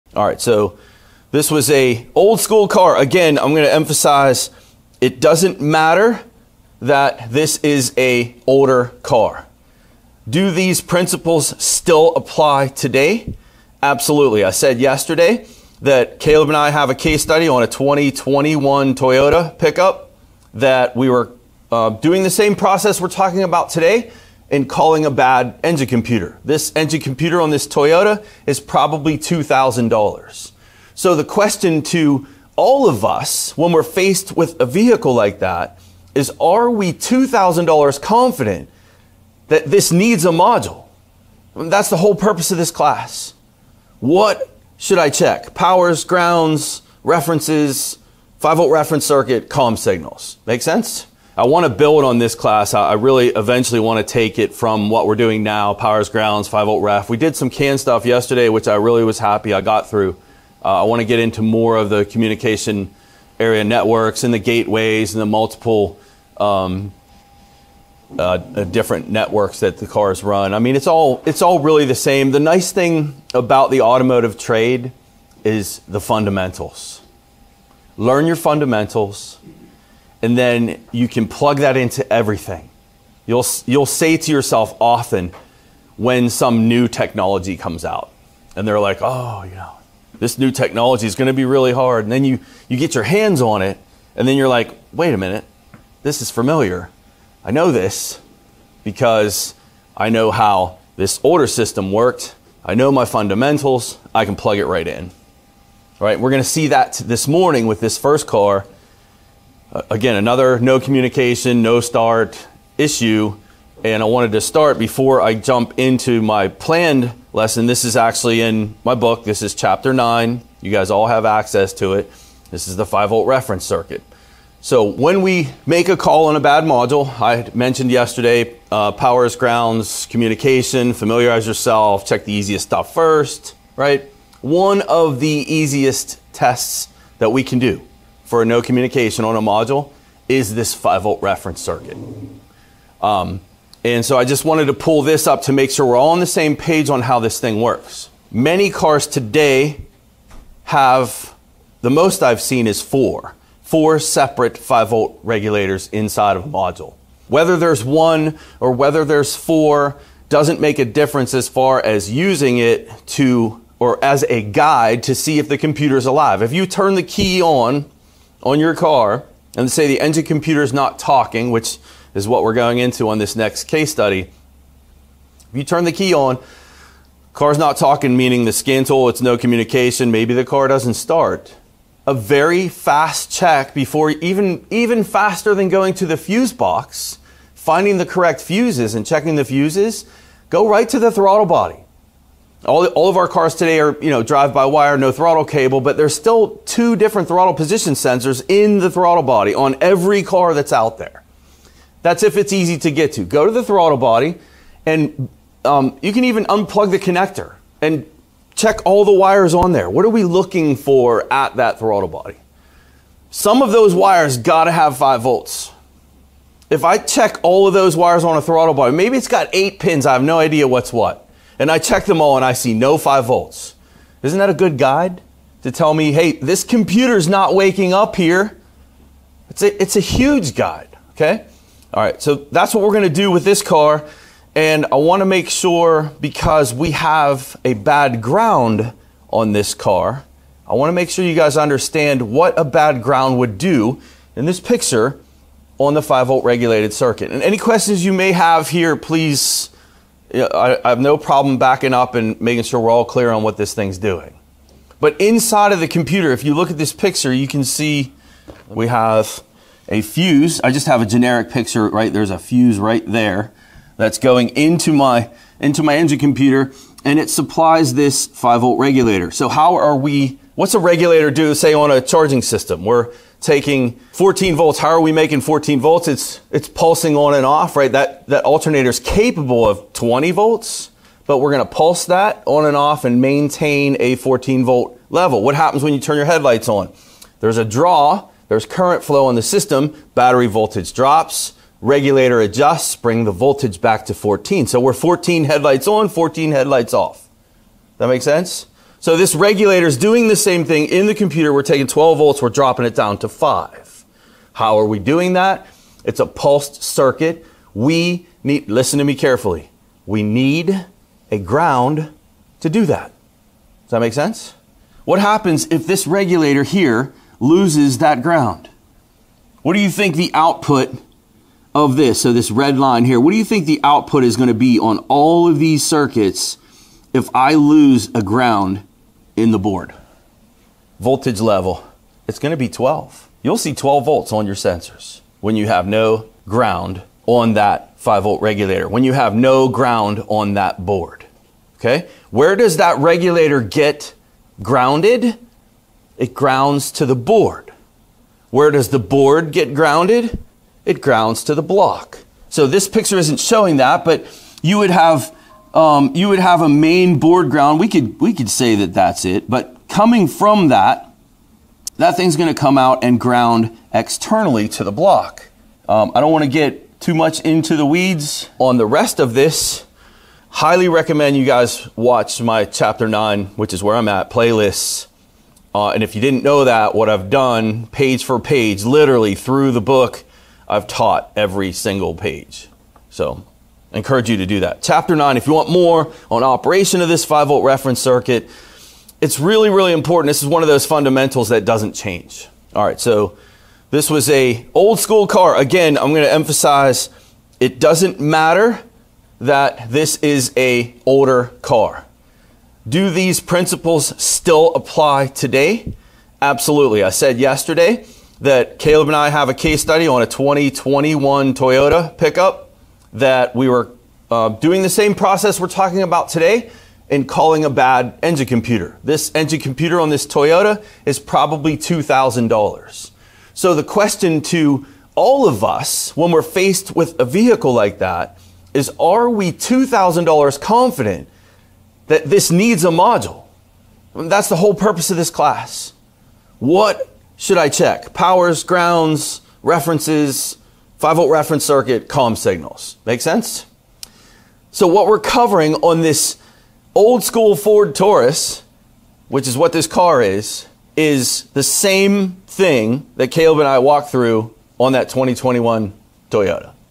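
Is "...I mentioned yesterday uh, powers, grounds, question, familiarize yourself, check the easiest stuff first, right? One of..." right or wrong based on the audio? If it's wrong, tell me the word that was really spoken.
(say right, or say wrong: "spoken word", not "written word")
wrong: "communication", not "question".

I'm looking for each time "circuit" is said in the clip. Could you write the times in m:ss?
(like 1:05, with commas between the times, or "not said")
0:49, 2:03, 2:21, 4:06, 5:06, 5:25, 6:27, 7:21.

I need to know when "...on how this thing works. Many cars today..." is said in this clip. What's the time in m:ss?
2:26.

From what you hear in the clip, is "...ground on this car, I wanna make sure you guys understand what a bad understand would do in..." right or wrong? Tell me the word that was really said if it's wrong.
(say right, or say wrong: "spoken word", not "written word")
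wrong: "ground", not "understand".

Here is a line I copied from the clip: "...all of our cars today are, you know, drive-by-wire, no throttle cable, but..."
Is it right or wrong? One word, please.
right.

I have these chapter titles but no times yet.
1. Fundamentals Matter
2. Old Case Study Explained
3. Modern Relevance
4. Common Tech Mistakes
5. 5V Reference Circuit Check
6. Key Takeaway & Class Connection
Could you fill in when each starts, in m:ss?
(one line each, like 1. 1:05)
1. 0:30
2. 1:30
3. 2:30
4. 3:30
5. 5:30
6. 6:30.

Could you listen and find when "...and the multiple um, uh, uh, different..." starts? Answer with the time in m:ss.
1:05.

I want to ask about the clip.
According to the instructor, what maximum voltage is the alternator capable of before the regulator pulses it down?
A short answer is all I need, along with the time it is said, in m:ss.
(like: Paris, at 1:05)
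20 volts, at 4:39.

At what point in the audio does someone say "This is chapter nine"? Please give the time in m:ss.
1:59.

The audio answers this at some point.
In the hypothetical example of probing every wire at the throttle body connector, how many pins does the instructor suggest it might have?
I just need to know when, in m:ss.
3:39.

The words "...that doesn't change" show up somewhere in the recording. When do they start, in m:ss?
6:31.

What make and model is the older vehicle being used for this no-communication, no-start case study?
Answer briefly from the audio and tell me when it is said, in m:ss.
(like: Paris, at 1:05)
Ford Taurus, at 7:27.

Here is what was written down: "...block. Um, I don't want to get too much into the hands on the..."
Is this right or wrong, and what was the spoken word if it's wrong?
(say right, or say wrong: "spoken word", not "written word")
wrong: "weeds", not "hands".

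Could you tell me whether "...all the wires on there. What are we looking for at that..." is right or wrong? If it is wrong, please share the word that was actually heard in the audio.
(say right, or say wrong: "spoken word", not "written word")
right.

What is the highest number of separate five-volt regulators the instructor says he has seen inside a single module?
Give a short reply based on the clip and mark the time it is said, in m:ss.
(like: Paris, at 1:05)
4, at 2:33.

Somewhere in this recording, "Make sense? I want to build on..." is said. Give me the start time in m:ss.
0:50.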